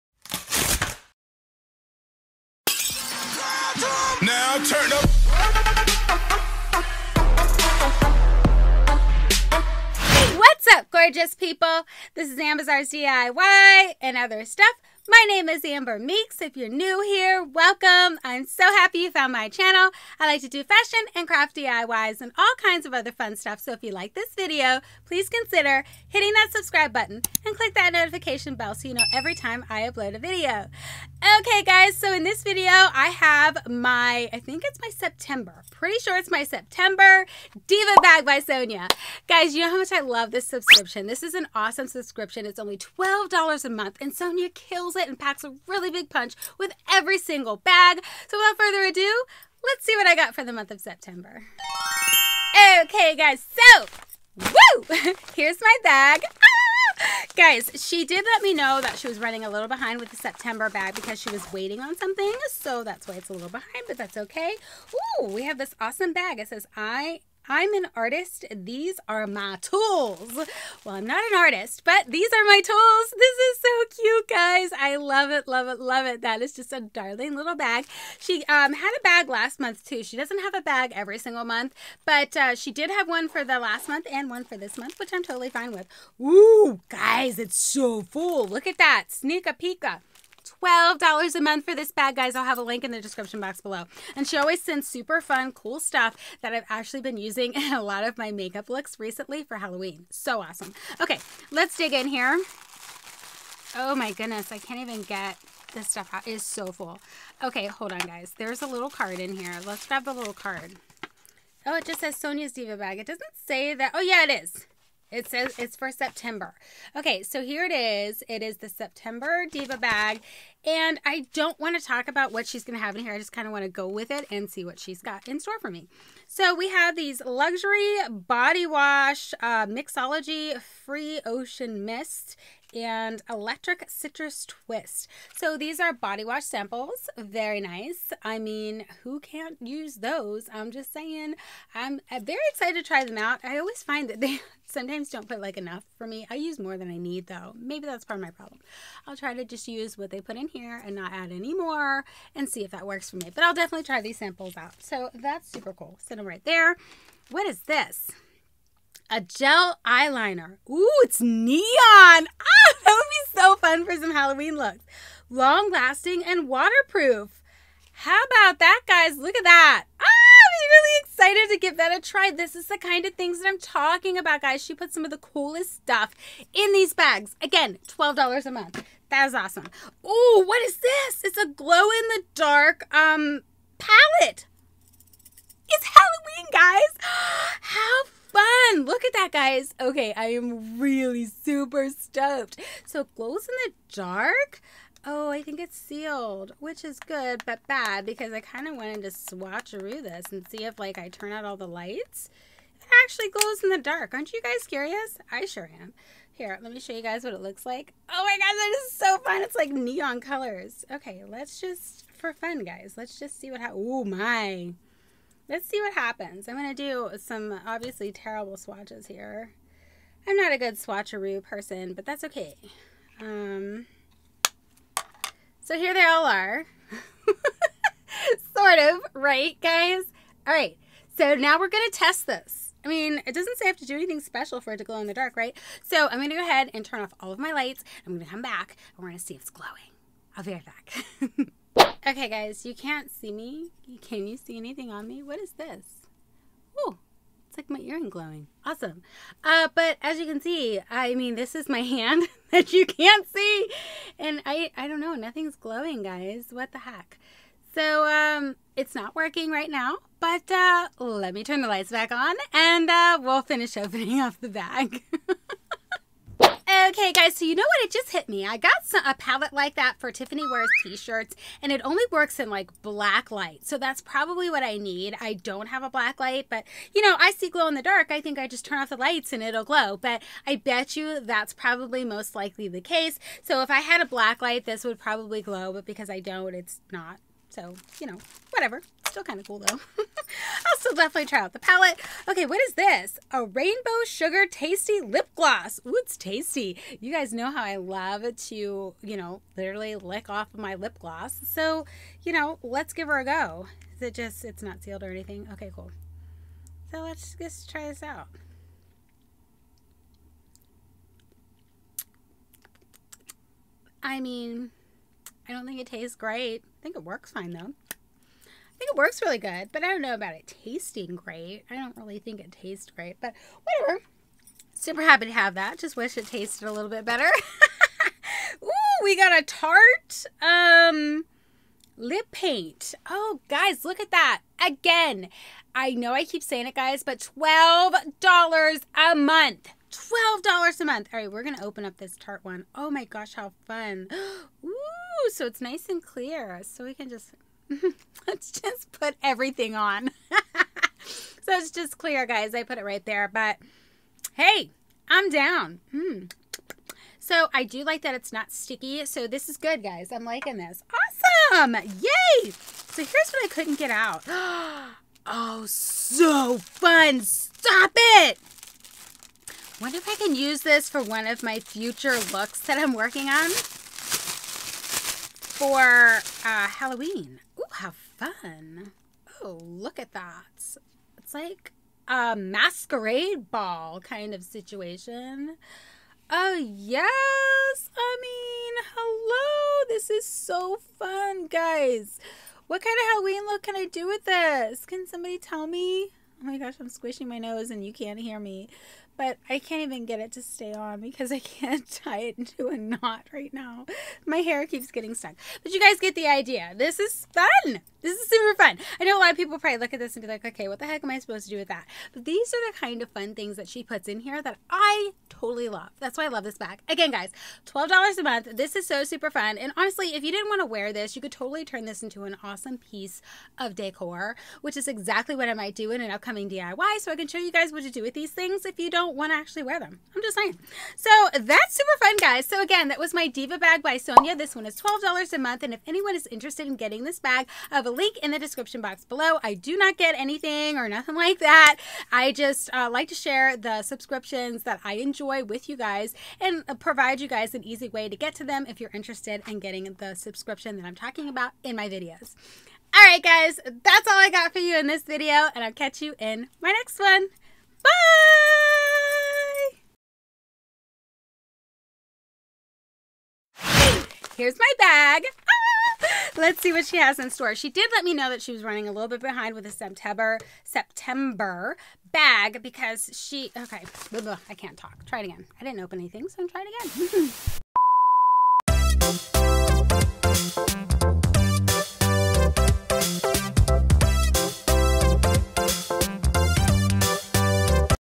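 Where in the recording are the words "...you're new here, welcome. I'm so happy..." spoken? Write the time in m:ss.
0:16.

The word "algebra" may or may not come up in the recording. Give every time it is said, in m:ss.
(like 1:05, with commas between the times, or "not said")
not said.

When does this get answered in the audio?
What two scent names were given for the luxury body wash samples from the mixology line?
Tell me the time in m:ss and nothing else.
2:10.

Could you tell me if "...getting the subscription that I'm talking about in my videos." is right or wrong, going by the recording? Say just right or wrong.
right.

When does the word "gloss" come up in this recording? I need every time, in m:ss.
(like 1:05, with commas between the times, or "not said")
4:55, 5:00.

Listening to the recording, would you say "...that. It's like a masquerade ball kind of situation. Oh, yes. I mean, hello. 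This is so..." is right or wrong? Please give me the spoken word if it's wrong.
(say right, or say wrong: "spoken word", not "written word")
right.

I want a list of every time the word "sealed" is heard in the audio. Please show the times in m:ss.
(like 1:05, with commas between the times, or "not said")
3:15, 5:04.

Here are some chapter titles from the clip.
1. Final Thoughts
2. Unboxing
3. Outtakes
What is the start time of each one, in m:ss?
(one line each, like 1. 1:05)
1. 7:10
2. 0:52
3. 7:39.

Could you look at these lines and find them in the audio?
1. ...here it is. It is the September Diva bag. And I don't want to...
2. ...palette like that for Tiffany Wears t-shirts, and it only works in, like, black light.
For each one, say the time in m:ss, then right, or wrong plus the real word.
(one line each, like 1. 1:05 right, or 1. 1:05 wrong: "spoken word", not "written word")
1. 1:57 right
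2. 4:29 right.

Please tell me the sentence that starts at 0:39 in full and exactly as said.
Guys, you know how much I love this subscription.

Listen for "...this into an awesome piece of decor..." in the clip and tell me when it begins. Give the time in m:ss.
7:01.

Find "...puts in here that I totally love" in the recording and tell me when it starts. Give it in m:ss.
6:53.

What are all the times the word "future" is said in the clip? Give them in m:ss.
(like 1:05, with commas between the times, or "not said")
6:11.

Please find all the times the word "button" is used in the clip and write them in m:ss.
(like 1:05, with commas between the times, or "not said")
0:26.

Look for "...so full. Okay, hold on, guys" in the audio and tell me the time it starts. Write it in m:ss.
1:46.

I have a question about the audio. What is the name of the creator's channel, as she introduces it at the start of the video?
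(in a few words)
Ambizzares DIY and other stuff.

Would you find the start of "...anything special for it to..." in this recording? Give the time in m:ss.
3:53.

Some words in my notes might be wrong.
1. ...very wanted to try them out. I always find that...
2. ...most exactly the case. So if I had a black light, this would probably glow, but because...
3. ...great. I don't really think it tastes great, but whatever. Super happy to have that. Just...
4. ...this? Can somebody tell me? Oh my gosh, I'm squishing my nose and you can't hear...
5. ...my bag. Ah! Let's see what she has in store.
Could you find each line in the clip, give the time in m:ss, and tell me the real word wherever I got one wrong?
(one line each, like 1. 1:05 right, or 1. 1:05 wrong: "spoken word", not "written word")
1. 2:22 wrong: "excited", not "wanted"
2. 4:42 wrong: "likely", not "exactly"
3. 5:21 right
4. 6:34 right
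5. 7:44 right.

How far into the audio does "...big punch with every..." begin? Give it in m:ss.
0:45.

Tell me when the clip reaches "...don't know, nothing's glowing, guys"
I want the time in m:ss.
4:14.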